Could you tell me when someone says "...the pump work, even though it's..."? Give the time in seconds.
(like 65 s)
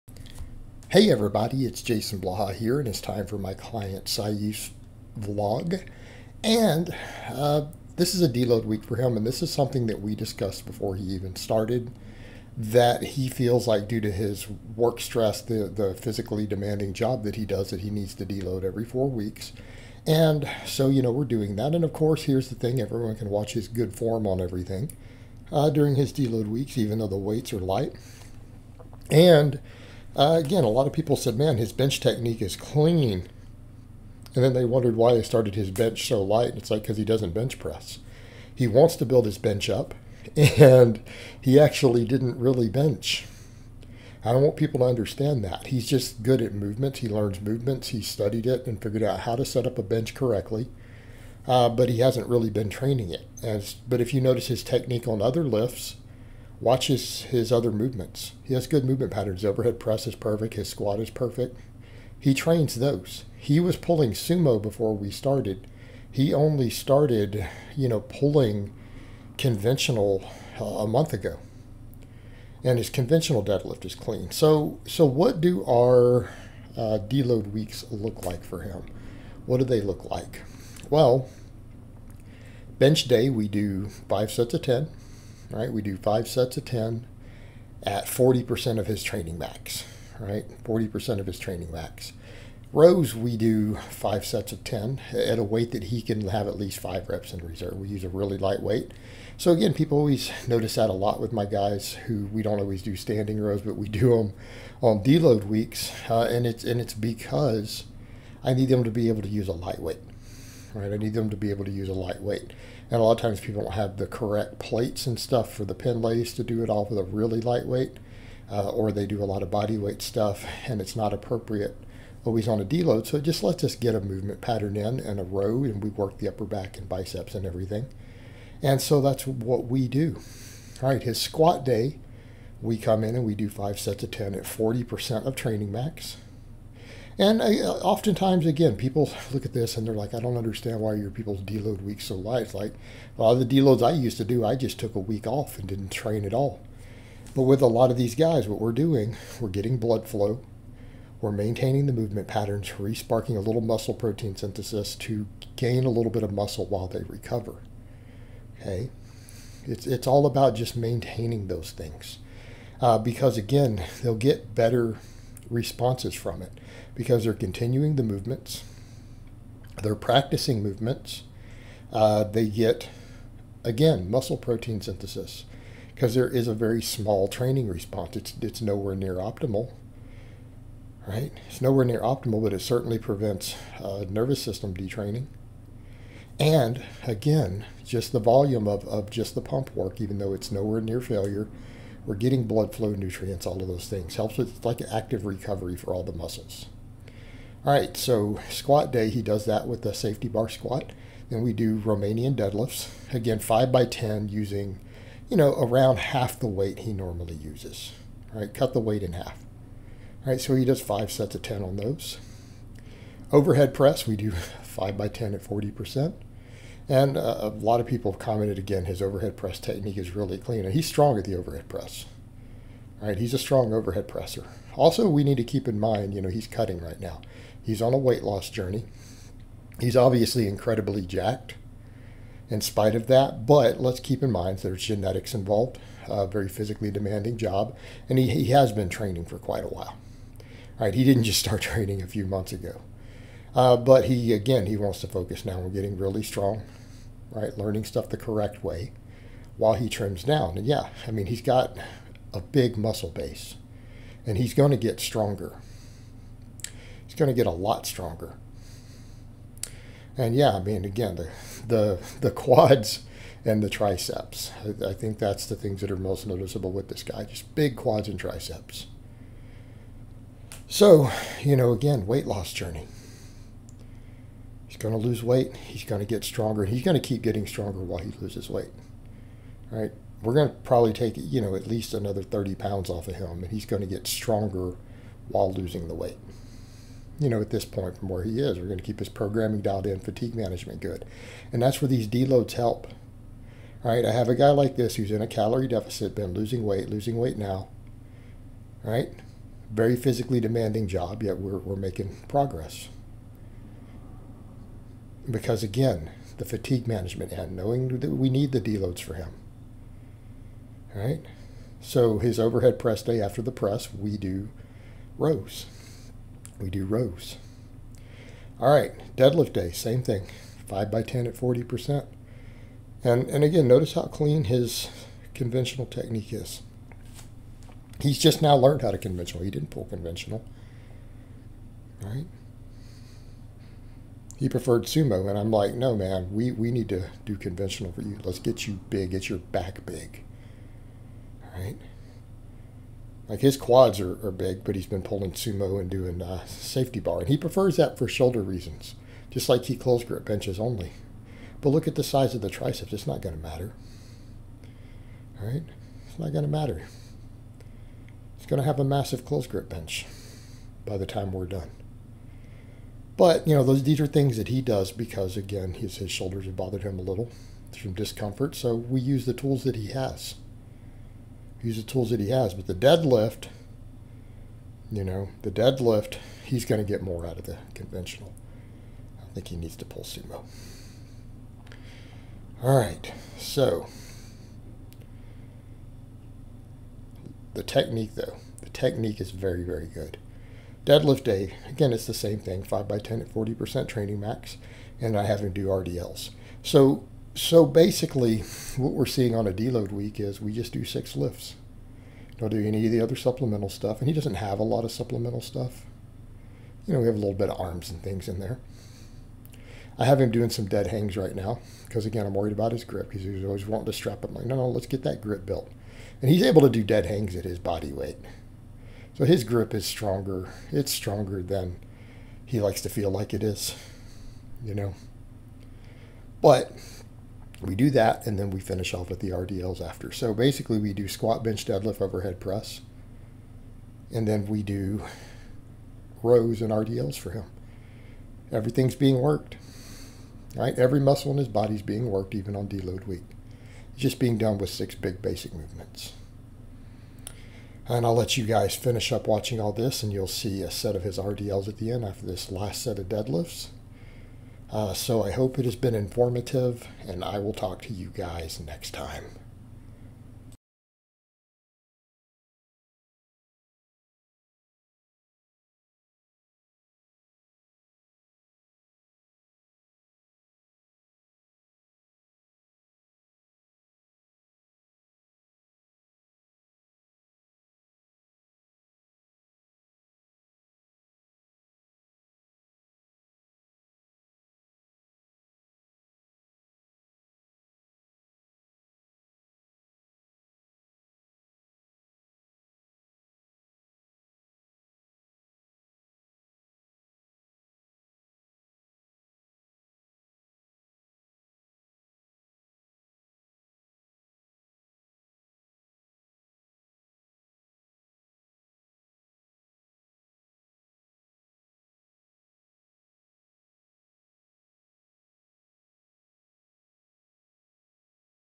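189 s.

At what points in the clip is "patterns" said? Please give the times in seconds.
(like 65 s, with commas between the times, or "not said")
59 s, 124 s, 152 s.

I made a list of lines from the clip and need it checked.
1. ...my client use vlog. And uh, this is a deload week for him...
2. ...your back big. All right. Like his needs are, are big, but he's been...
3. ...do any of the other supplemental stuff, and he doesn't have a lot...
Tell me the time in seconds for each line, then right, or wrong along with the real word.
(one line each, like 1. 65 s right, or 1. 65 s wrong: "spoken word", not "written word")
1. 3 s right
2. 339 s wrong: "quads", not "needs"
3. 402 s right.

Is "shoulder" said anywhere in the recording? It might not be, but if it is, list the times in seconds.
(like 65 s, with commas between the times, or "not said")
348 s, 366 s.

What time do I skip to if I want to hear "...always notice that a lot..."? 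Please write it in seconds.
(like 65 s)
99 s.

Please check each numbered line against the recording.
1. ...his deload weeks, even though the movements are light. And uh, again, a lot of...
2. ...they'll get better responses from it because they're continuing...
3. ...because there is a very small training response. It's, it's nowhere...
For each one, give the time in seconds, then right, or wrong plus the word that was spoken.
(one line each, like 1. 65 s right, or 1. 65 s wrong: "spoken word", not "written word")
1. 25 s wrong: "weights", not "movements"
2. 164 s right
3. 175 s right.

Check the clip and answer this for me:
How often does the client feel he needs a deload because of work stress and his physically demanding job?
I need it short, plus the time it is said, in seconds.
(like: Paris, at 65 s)
every four weeks, at 18 s.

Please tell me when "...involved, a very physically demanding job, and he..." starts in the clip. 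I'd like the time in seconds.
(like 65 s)
235 s.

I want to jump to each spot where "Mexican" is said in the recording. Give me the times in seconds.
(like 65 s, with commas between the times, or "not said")
not said.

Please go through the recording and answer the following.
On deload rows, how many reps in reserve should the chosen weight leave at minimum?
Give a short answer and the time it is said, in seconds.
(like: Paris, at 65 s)
5, at 96 s.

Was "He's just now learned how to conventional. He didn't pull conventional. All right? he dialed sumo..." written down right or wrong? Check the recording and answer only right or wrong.
wrong.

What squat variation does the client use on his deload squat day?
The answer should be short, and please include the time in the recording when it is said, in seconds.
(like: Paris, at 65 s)
safety bar squat, at 199 s.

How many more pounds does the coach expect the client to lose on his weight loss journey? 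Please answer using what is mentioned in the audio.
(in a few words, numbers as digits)
30 pounds.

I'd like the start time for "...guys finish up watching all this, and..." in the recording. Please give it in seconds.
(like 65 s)
448 s.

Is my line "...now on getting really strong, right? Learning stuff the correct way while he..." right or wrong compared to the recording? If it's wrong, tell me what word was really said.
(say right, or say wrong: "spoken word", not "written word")
right.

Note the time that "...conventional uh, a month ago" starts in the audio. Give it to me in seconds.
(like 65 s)
69 s.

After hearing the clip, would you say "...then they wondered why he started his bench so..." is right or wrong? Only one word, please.
right.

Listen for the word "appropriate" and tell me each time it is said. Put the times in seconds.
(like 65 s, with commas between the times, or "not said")
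121 s.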